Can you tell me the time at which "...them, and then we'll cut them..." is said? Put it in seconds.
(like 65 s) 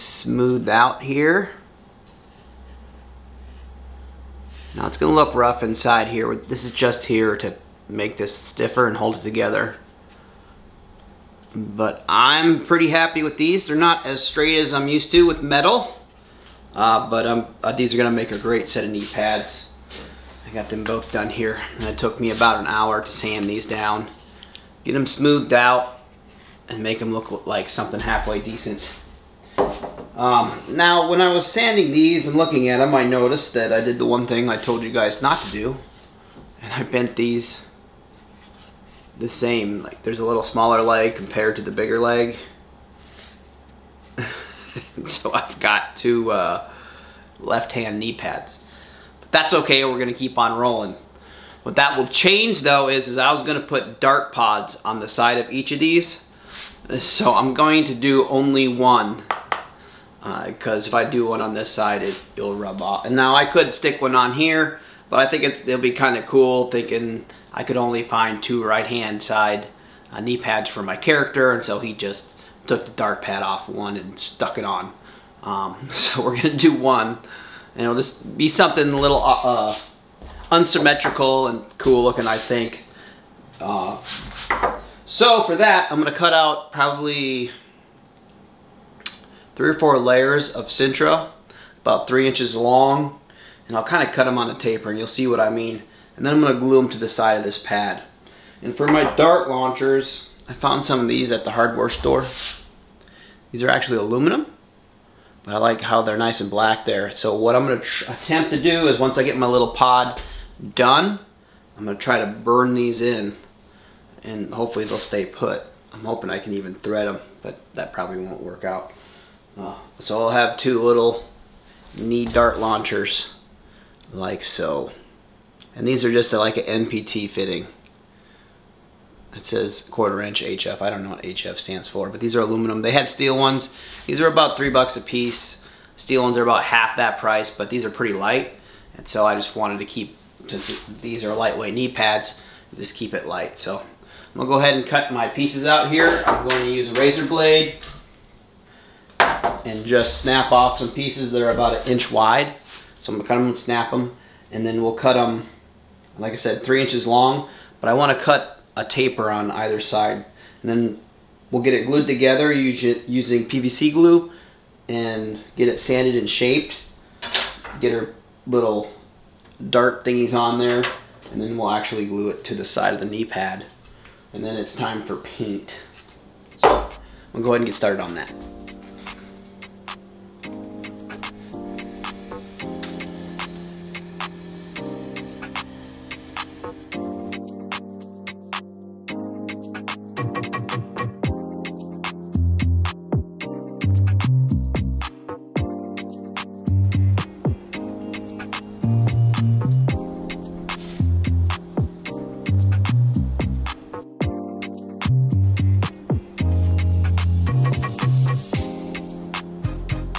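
153 s.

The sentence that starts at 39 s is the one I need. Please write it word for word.
Like, there's a little smaller leg compared to the bigger leg.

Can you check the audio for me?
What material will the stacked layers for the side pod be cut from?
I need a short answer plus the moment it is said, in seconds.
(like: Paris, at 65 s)
Sintra, at 90 s.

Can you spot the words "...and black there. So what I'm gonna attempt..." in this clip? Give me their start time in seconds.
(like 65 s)
106 s.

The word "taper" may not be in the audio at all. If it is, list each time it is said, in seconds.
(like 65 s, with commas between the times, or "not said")
94 s, 158 s.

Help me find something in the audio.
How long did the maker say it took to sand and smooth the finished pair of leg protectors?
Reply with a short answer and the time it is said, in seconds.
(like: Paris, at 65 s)
about an hour, at 22 s.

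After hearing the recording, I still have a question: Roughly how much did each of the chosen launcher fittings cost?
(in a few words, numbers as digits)
$3.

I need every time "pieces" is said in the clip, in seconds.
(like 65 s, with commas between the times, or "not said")
135 s, 145 s, 150 s.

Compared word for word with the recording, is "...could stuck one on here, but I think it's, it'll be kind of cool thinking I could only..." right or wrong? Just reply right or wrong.
wrong.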